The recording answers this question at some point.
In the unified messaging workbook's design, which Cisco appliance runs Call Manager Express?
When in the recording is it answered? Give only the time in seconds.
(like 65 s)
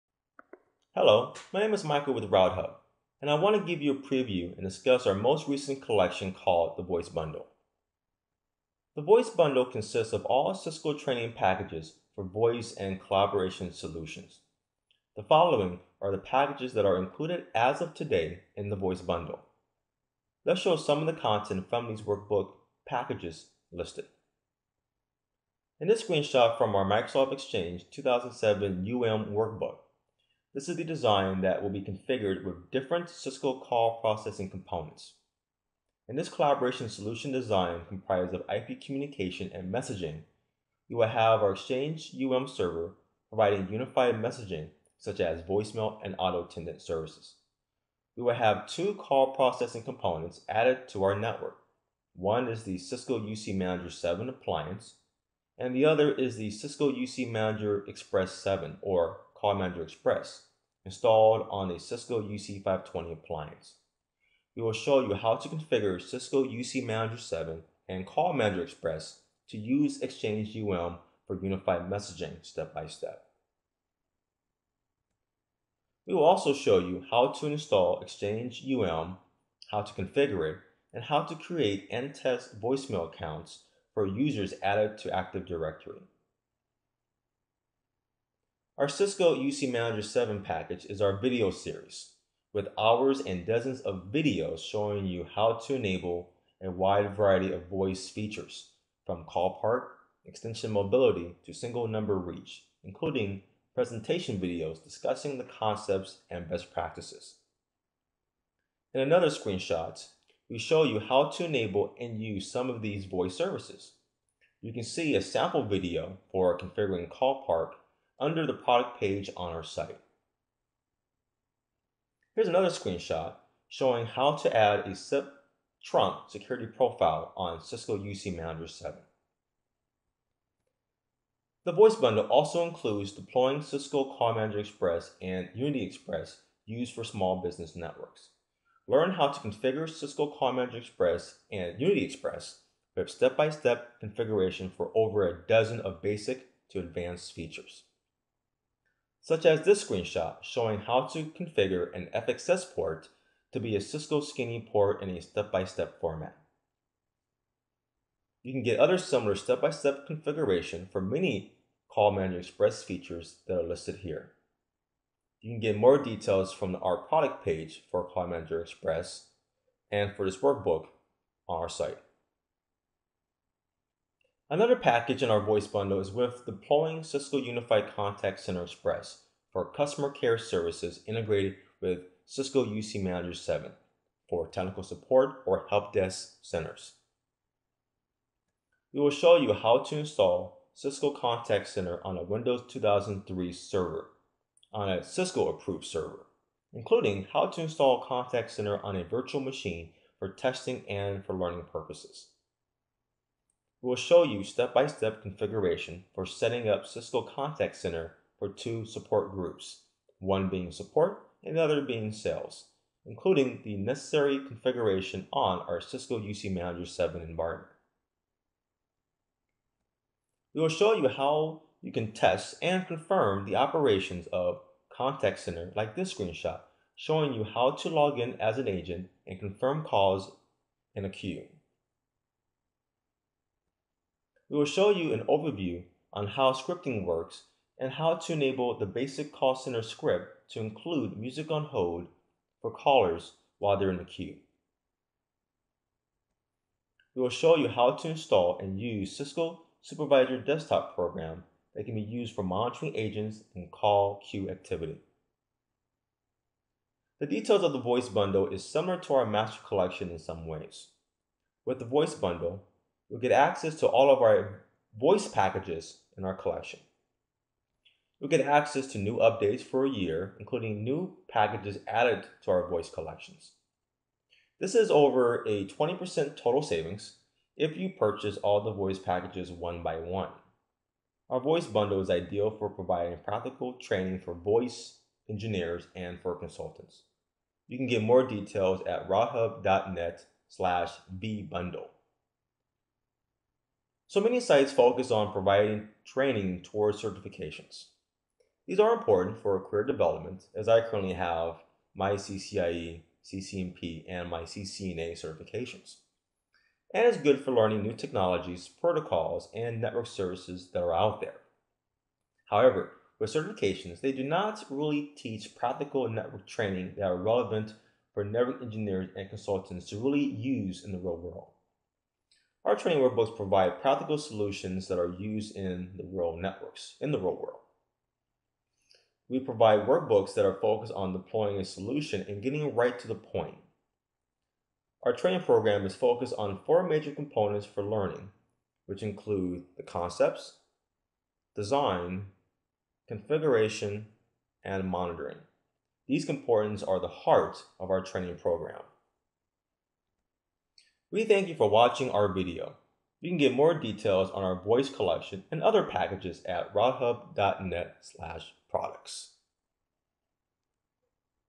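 62 s.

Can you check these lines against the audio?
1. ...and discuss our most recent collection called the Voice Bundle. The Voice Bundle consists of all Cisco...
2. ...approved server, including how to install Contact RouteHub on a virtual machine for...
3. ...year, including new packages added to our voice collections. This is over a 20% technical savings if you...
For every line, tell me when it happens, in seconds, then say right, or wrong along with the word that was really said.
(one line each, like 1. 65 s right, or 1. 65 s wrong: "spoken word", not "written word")
1. 4 s right
2. 195 s wrong: "Center", not "RouteHub"
3. 269 s wrong: "total", not "technical".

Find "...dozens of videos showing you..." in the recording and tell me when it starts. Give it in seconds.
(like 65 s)
93 s.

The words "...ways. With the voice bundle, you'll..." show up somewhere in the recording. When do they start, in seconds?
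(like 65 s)
260 s.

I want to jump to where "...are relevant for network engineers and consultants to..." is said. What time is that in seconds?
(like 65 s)
317 s.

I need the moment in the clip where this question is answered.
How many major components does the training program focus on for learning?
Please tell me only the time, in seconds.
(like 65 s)
336 s.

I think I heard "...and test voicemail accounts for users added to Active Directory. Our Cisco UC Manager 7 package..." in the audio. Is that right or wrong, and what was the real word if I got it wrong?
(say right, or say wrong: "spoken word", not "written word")
right.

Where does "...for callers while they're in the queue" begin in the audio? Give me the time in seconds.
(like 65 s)
242 s.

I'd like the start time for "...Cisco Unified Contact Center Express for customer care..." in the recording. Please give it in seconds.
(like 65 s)
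177 s.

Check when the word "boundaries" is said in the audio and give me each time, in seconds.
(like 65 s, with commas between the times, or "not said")
not said.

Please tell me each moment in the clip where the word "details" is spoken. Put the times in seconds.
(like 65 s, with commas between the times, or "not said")
165 s, 257 s, 288 s, 353 s.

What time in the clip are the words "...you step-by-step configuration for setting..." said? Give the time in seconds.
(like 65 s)
204 s.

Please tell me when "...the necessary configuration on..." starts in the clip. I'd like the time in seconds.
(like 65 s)
213 s.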